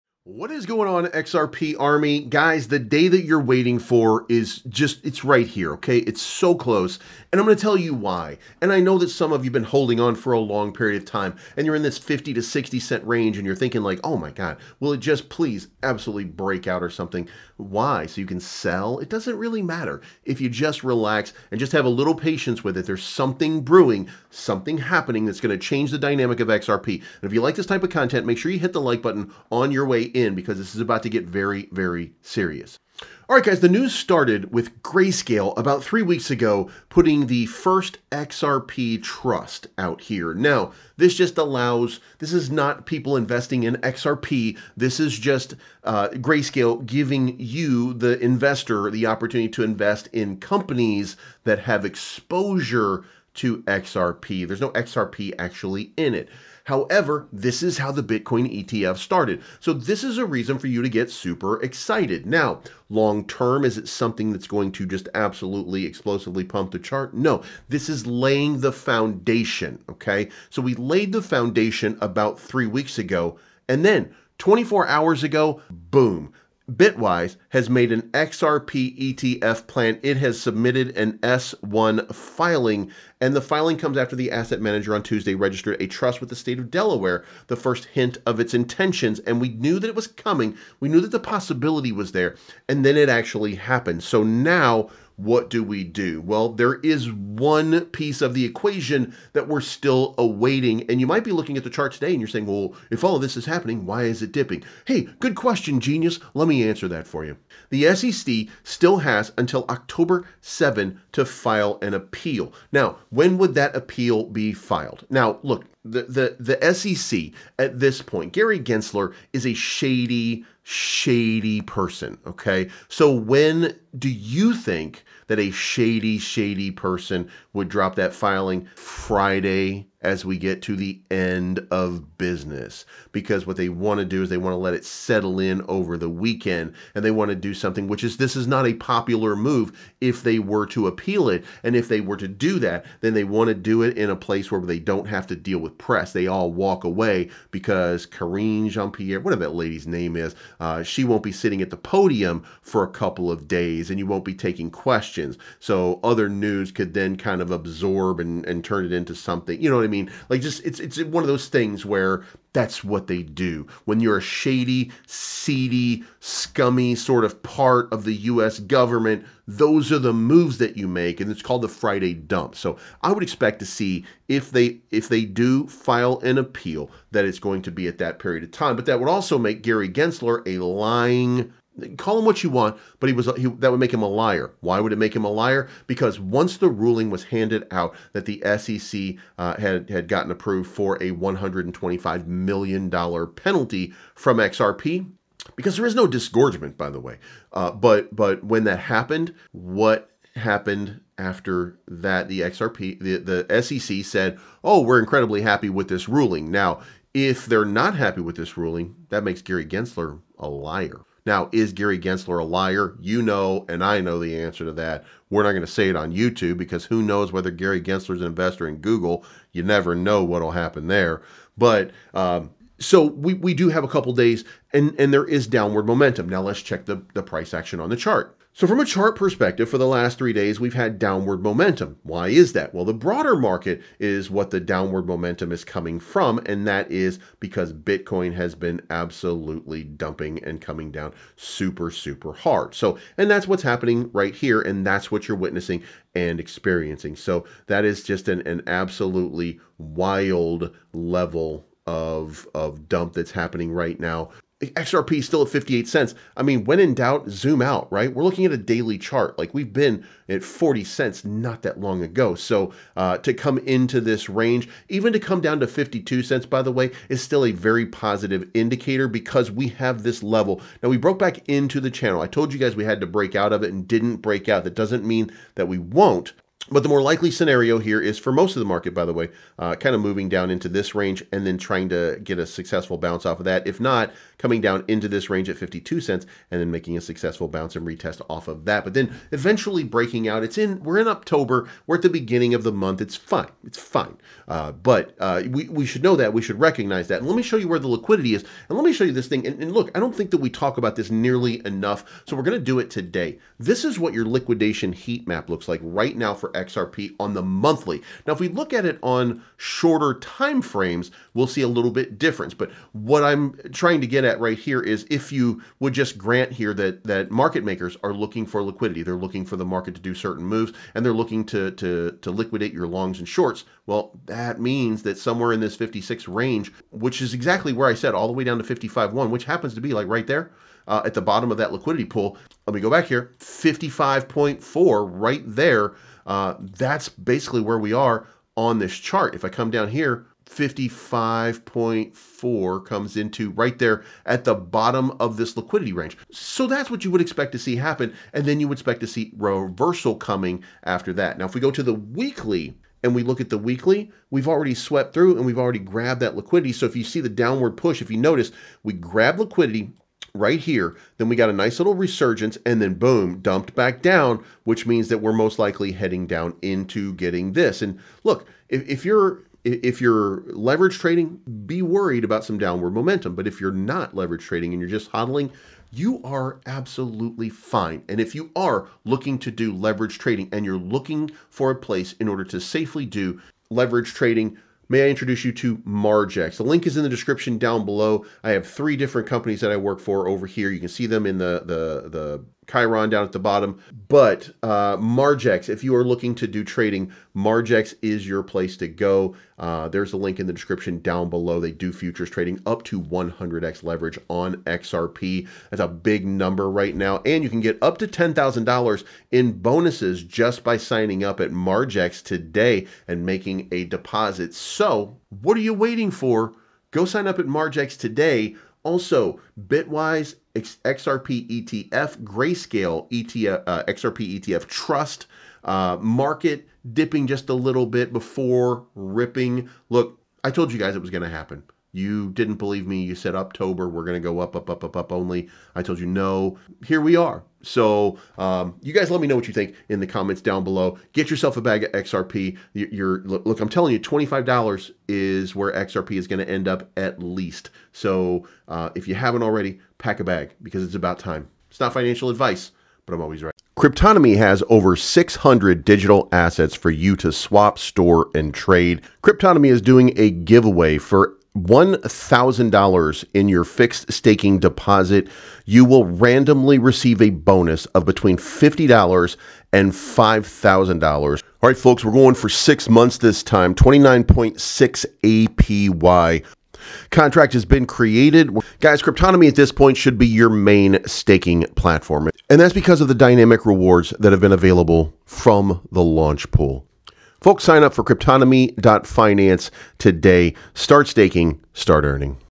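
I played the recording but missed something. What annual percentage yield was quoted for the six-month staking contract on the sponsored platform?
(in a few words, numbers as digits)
29.6.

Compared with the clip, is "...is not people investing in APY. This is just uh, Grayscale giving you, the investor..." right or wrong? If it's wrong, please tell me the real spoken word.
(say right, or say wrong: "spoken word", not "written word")
wrong: "XRP", not "APY".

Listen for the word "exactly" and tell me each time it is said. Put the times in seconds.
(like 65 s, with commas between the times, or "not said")
327 s.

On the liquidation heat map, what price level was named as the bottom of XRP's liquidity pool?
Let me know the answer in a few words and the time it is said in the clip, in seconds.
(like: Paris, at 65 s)
55.1, at 328 s.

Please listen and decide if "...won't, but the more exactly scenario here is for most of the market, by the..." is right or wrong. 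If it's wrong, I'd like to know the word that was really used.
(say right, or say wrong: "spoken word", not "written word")
wrong: "likely", not "exactly".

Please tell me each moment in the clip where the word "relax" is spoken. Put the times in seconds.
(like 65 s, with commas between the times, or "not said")
20 s.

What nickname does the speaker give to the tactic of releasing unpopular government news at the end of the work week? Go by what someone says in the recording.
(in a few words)
Friday dump.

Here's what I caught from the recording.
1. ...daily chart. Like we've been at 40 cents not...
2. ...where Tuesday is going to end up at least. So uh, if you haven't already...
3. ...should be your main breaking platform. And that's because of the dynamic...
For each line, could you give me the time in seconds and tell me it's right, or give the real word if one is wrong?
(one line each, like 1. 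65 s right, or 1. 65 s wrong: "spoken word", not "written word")
1. 258 s right
2. 445 s wrong: "XRP", not "Tuesday"
3. 479 s wrong: "staking", not "breaking".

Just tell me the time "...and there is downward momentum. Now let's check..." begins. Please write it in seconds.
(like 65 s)
224 s.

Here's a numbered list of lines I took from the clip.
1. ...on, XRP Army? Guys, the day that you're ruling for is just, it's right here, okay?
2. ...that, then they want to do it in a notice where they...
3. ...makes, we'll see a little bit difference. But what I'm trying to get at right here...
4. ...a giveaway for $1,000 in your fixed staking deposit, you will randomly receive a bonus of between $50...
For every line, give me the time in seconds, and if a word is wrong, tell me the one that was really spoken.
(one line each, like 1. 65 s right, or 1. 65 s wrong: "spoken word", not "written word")
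1. 0 s wrong: "waiting", not "ruling"
2. 142 s wrong: "place", not "notice"
3. 310 s wrong: "frames", not "makes"
4. 460 s right.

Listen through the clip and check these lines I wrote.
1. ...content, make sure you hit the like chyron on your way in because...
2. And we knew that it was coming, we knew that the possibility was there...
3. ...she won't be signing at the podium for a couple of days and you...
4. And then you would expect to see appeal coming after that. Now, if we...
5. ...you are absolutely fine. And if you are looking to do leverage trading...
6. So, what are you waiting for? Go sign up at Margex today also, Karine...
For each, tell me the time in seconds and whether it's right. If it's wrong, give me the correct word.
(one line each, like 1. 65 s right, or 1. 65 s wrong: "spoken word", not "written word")
1. 27 s wrong: "button", not "chyron"
2. 89 s right
3. 150 s wrong: "sitting", not "signing"
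4. 348 s wrong: "reversal", not "appeal"
5. 375 s right
6. 414 s wrong: "Bitwise", not "Karine".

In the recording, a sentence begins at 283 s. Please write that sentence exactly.
If not, coming down into this range at 52 cents and then making a successful bounce and retest off of that.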